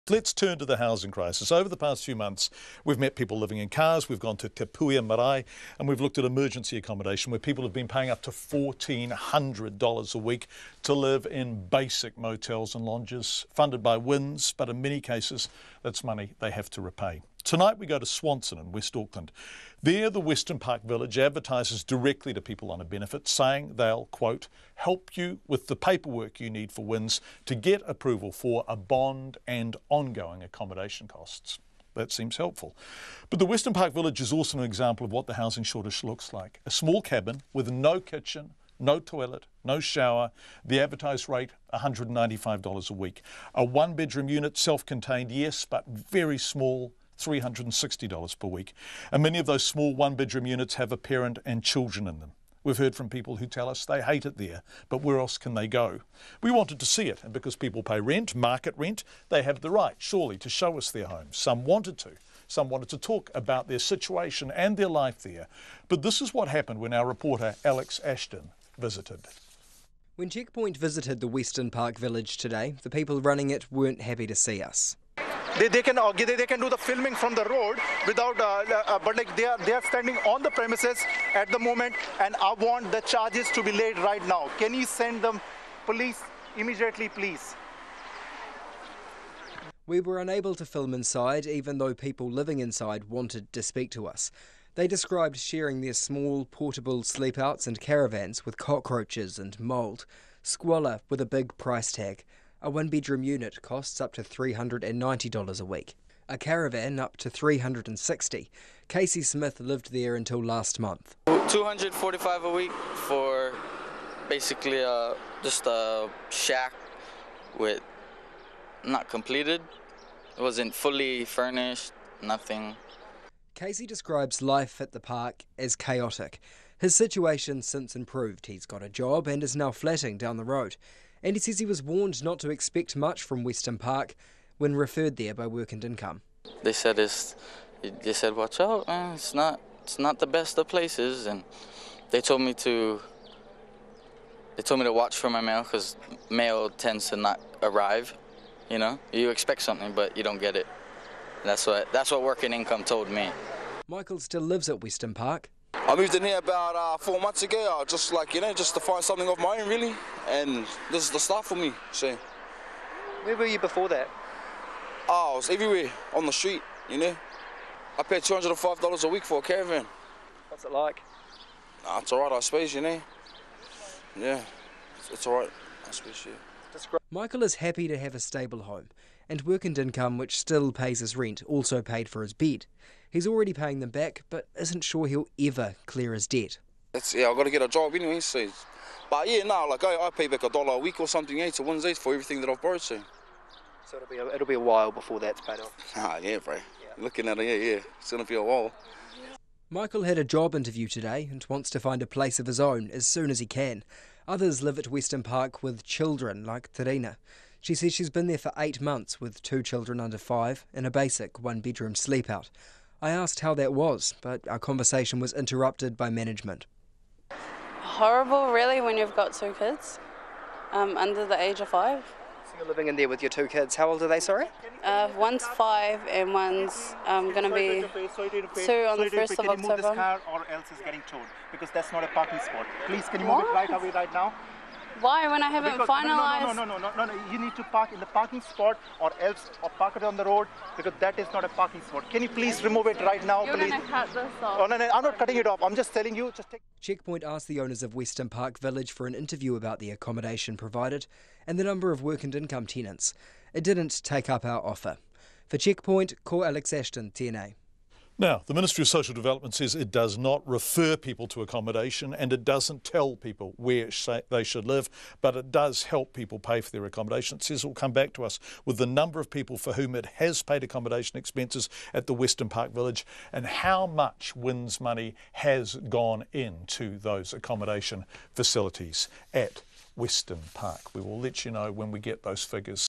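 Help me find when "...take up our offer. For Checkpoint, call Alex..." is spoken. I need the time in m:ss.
4:14.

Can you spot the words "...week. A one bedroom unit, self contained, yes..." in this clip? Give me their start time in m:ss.
0:42.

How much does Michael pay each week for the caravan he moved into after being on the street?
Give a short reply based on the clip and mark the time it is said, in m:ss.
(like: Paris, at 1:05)
$205, at 2:48.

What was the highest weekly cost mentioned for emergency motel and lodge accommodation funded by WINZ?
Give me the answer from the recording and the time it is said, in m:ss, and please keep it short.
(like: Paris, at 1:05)
$1,400, at 0:08.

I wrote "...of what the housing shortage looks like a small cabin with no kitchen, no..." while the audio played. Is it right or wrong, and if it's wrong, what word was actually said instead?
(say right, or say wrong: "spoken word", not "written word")
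right.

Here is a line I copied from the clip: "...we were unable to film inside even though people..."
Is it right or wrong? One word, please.
right.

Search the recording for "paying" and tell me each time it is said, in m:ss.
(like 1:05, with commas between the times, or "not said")
0:07, 3:03.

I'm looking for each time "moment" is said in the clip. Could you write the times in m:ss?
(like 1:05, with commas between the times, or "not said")
1:21.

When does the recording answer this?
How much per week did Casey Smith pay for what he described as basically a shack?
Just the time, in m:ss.
1:51.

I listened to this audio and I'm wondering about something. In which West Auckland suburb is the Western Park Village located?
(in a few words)
Swanson.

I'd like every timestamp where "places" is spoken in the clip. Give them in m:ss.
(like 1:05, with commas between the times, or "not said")
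2:20, 3:22.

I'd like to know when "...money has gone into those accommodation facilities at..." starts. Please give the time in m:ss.
4:34.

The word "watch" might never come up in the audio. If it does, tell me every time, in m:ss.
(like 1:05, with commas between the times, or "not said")
2:18, 2:24.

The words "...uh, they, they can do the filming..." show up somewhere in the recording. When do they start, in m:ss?
1:15.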